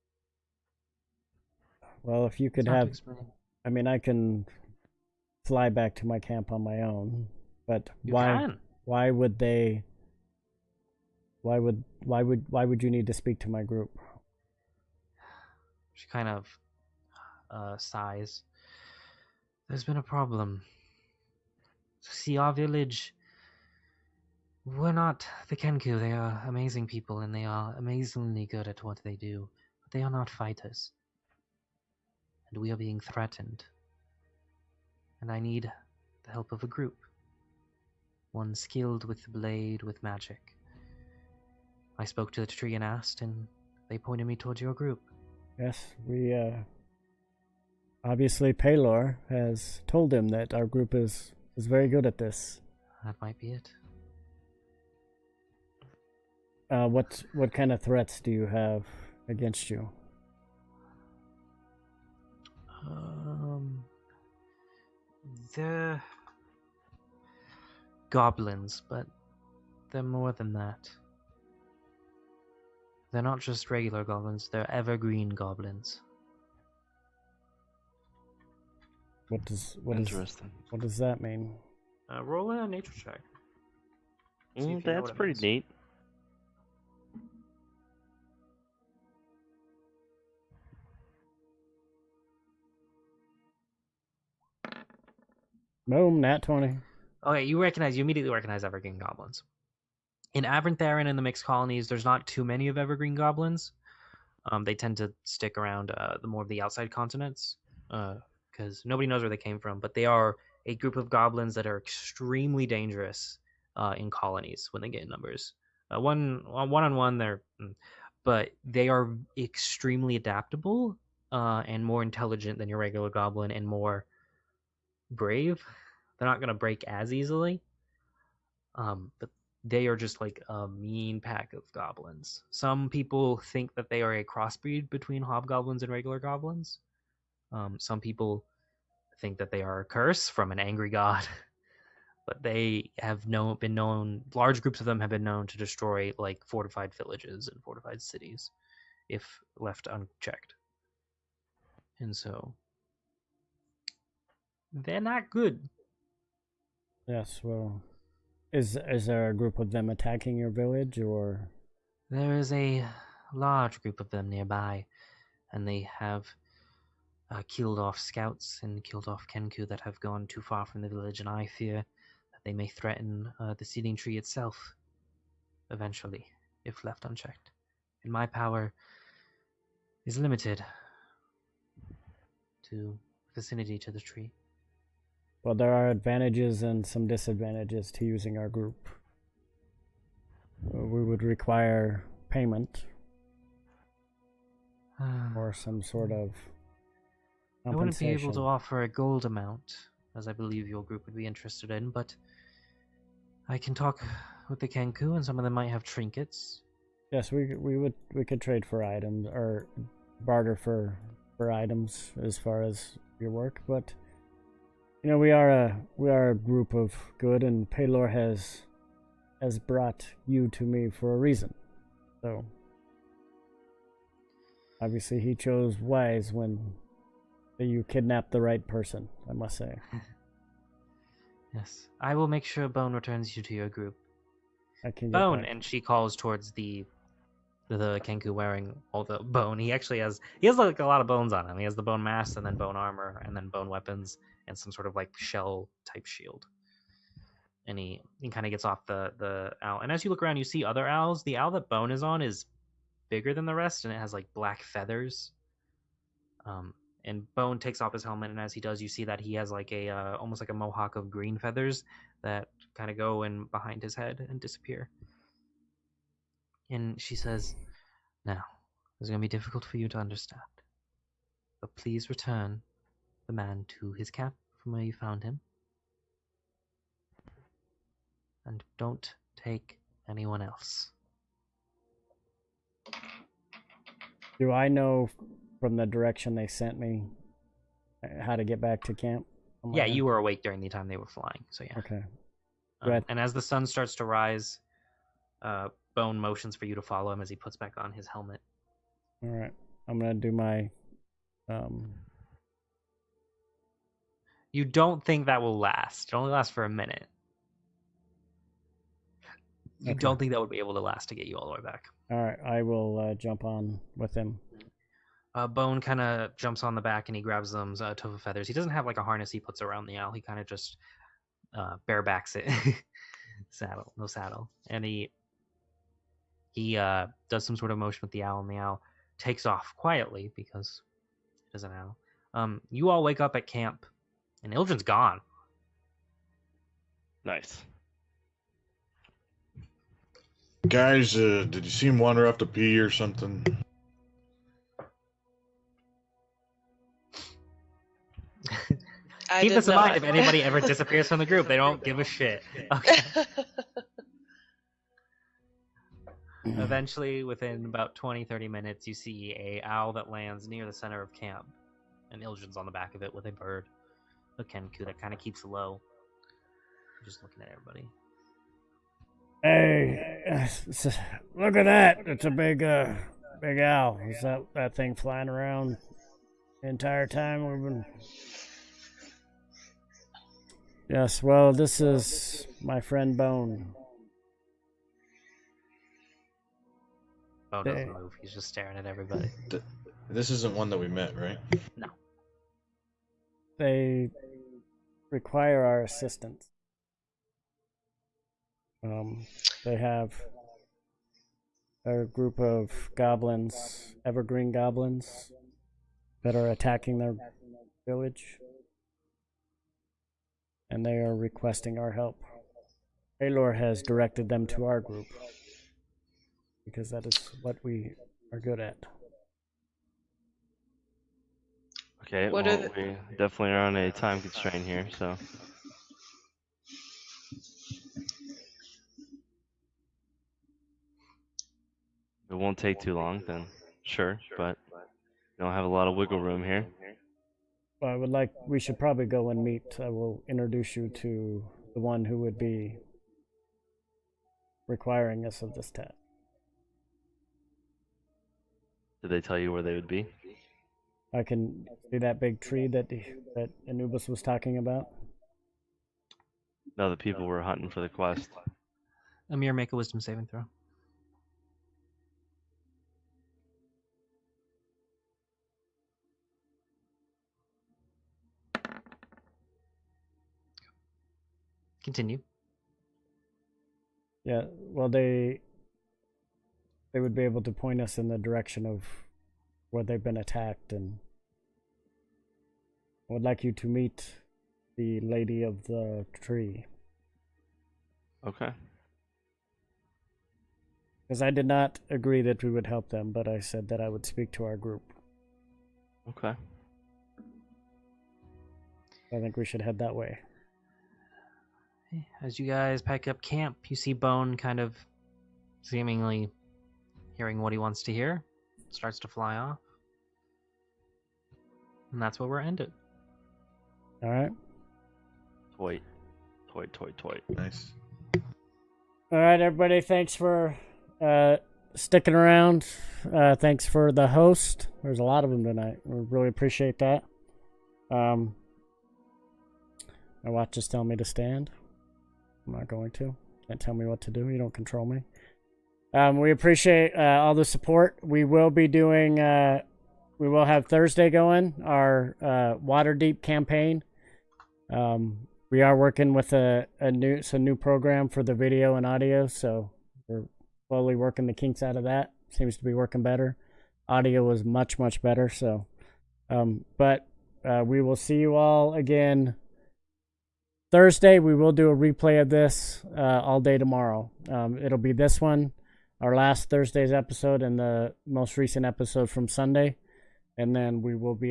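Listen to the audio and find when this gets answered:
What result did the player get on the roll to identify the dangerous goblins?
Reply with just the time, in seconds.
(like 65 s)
96 s.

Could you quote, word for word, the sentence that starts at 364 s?
But Kenku, that kind of keeps low.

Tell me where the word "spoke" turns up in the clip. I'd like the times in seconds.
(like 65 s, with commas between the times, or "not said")
42 s.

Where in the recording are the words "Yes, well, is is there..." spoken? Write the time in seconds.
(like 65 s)
157 s.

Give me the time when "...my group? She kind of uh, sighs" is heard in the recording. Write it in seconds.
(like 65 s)
13 s.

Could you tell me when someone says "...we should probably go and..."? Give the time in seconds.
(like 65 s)
438 s.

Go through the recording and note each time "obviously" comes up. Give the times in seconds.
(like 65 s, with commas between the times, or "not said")
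48 s, 224 s.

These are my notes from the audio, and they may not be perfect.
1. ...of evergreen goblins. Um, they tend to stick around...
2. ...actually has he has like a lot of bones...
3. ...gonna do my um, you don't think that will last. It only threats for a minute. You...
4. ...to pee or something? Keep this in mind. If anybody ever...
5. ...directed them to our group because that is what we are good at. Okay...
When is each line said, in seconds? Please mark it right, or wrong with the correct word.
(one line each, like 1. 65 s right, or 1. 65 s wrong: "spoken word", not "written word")
1. 102 s right
2. 239 s right
3. 299 s wrong: "lasts", not "threats"
4. 342 s right
5. 413 s right.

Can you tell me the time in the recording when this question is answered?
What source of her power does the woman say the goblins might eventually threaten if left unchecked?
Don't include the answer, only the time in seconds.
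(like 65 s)
173 s.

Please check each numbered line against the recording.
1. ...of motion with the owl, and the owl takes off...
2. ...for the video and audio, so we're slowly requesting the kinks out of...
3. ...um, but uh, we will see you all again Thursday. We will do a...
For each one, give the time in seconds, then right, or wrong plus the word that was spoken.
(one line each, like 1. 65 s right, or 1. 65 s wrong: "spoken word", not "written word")
1. 327 s right
2. 548 s wrong: "working", not "requesting"
3. 556 s right.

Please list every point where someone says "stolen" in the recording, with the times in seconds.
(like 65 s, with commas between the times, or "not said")
not said.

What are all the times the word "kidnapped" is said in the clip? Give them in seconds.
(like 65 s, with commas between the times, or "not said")
227 s.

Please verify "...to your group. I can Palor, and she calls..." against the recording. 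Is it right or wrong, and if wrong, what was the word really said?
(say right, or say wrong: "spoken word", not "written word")
wrong: "Bone", not "Palor".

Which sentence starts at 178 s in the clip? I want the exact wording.
And my power is limited to vicinity to the tree.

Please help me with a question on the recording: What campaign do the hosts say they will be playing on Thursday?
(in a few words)
Waterdeep.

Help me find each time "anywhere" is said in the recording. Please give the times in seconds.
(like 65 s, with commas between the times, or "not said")
not said.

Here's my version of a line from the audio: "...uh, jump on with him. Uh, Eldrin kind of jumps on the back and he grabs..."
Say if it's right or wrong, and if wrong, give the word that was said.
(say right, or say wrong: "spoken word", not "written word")
wrong: "Bone", not "Eldrin".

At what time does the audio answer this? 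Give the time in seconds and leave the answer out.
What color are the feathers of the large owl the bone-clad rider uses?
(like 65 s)
254 s.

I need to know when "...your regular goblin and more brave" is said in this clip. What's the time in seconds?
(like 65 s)
122 s.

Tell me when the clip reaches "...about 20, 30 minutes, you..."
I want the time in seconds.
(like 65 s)
357 s.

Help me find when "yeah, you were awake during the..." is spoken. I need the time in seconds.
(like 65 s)
289 s.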